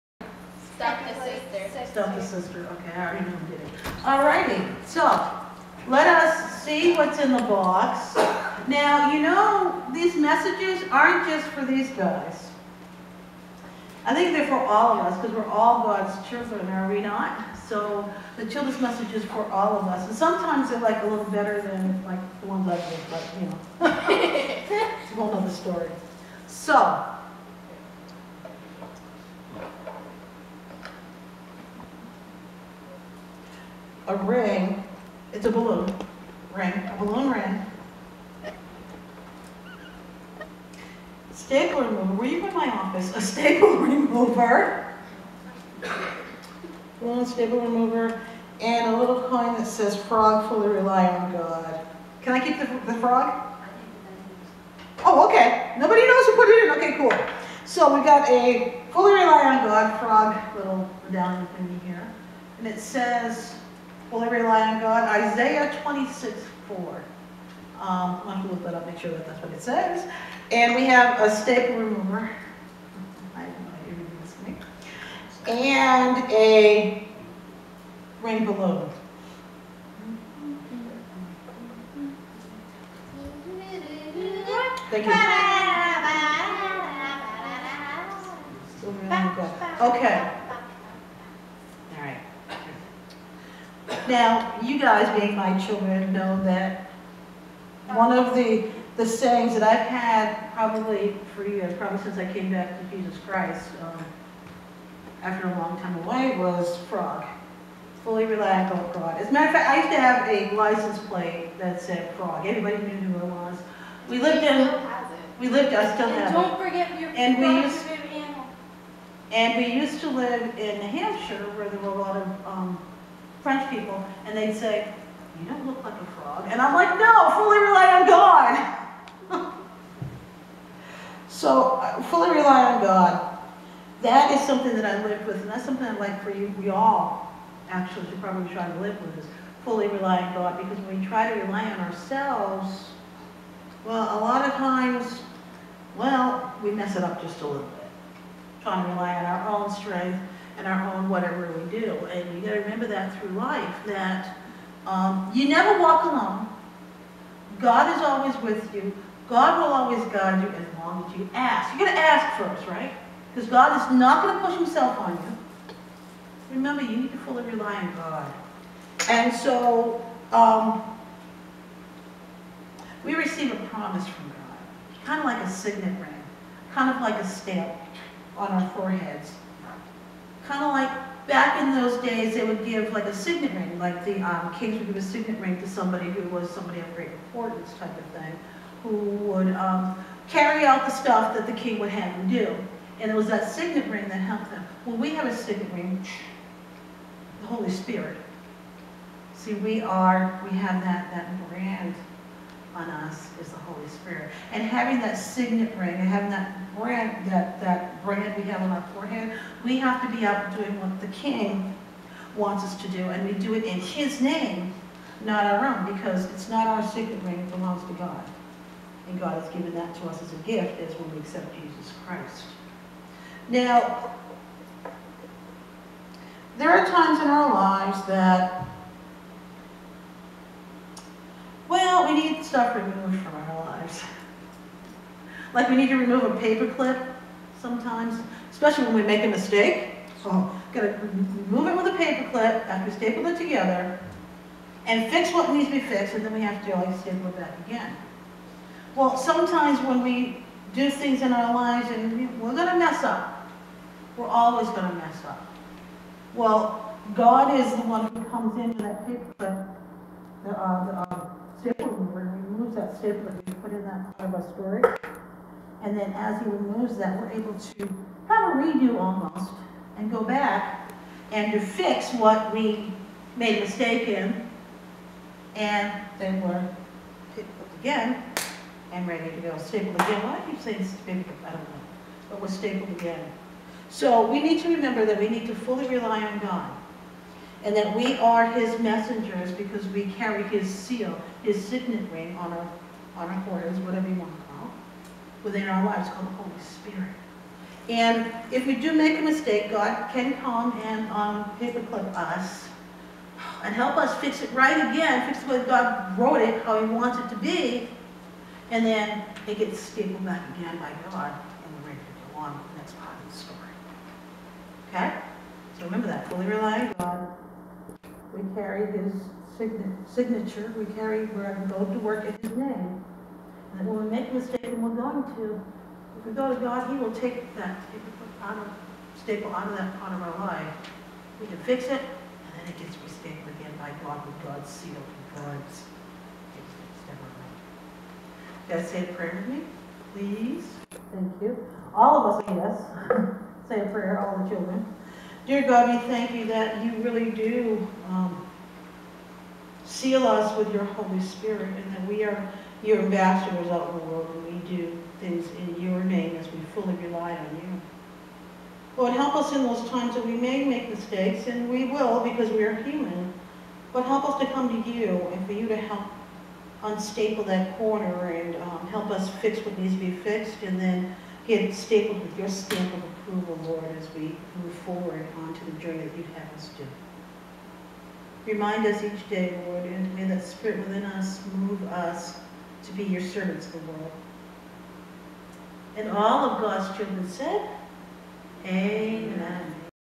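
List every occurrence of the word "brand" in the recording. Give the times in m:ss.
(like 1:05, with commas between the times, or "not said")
3:21, 3:26.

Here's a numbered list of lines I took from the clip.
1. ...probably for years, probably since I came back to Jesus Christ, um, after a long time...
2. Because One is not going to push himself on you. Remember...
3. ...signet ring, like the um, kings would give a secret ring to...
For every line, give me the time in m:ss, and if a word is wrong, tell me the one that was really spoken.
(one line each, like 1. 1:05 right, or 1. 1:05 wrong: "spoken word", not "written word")
1. 1:40 right
2. 2:43 wrong: "God", not "One"
3. 3:03 wrong: "signet", not "secret".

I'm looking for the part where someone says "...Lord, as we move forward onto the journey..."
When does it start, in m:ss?
6:13.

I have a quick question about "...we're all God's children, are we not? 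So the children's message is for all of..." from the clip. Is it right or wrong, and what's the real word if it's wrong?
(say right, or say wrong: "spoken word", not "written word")
right.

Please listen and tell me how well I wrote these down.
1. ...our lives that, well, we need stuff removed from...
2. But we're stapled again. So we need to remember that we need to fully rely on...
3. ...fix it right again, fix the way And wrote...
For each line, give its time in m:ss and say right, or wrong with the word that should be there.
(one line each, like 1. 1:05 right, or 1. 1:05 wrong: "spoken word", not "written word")
1. 3:47 right
2. 4:42 right
3. 5:04 wrong: "God", not "And".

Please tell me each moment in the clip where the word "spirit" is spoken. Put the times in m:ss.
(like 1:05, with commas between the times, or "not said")
3:17, 3:23, 4:56, 5:51, 6:20.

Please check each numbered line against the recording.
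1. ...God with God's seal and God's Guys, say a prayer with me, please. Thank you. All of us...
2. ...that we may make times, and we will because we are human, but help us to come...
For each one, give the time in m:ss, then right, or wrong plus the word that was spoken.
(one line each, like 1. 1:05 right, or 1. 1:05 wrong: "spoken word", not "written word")
1. 5:34 right
2. 6:00 wrong: "mistakes", not "times".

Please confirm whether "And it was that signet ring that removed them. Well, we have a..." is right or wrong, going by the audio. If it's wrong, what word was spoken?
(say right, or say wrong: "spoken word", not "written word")
wrong: "helped", not "removed".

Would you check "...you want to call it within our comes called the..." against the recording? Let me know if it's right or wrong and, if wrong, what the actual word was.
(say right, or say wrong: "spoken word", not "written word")
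wrong: "lives", not "comes".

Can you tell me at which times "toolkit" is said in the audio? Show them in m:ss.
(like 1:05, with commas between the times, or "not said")
not said.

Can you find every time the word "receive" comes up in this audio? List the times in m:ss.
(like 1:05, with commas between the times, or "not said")
2:53.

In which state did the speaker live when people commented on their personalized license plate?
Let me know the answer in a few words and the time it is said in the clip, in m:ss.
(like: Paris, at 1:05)
New Hampshire, at 2:00.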